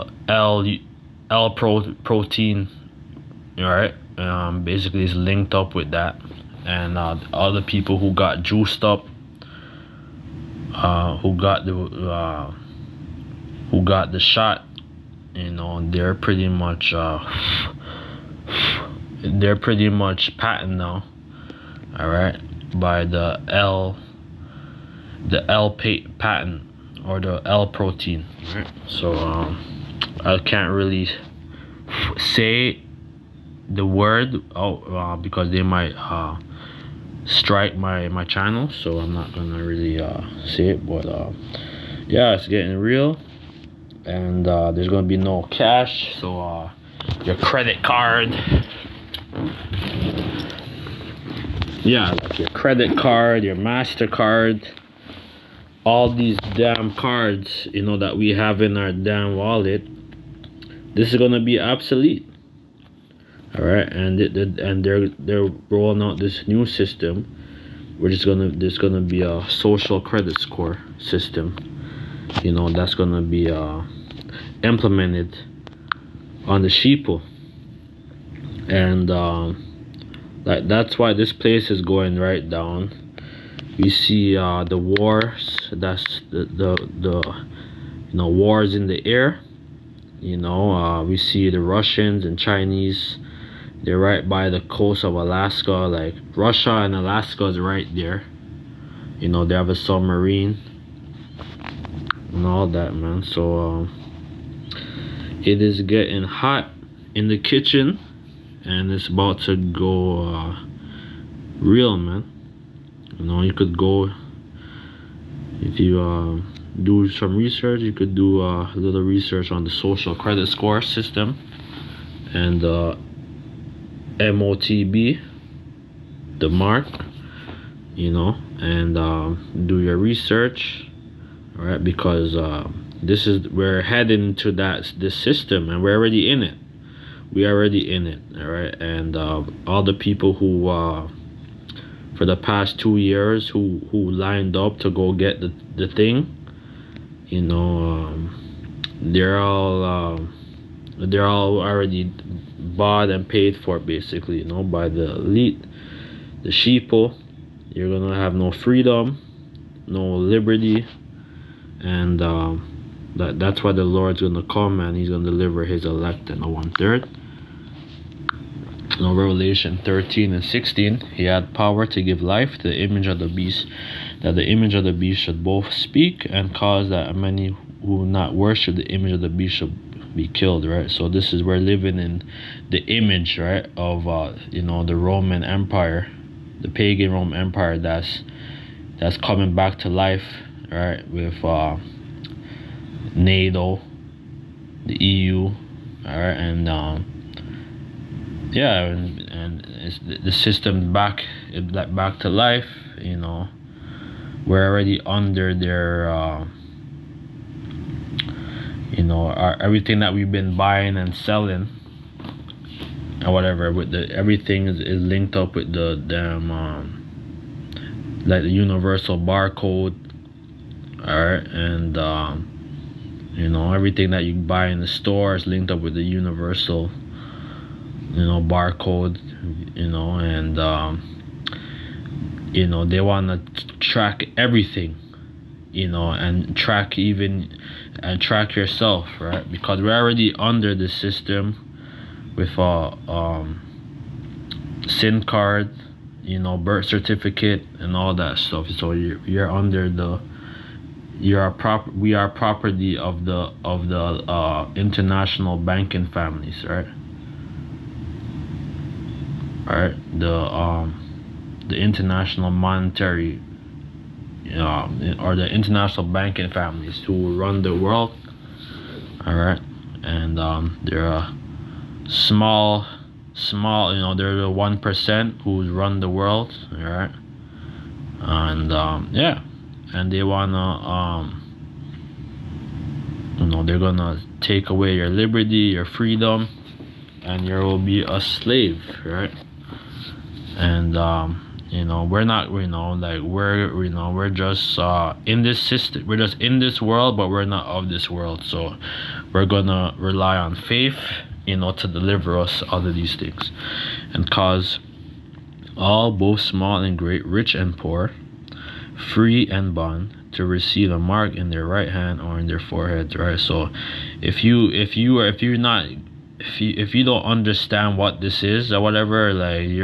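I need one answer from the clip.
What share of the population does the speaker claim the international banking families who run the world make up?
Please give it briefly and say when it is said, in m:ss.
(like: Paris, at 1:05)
1 percent, at 4:34.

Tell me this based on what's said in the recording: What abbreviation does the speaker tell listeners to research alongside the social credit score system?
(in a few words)
MOTB.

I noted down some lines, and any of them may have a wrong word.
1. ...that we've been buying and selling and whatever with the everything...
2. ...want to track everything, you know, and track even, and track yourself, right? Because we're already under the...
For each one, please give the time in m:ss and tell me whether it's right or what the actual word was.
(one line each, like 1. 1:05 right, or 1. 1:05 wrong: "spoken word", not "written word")
1. 3:29 right
2. 3:52 right.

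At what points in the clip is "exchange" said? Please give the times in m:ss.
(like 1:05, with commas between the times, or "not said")
not said.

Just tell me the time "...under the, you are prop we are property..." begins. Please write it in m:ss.
4:09.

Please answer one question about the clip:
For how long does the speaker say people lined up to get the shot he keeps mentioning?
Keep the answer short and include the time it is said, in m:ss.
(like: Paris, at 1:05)
2 years, at 2:22.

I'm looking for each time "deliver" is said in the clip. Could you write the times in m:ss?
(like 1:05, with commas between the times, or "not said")
2:45, 5:01.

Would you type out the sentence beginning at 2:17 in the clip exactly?
We already in it, all right.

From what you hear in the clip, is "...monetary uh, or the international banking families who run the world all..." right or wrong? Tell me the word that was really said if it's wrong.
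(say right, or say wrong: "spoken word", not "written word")
right.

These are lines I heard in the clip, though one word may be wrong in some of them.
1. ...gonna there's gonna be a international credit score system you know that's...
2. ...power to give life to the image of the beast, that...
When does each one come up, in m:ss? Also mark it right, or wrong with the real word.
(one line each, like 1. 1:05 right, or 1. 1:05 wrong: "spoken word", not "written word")
1. 1:08 wrong: "social", not "international"
2. 2:51 right.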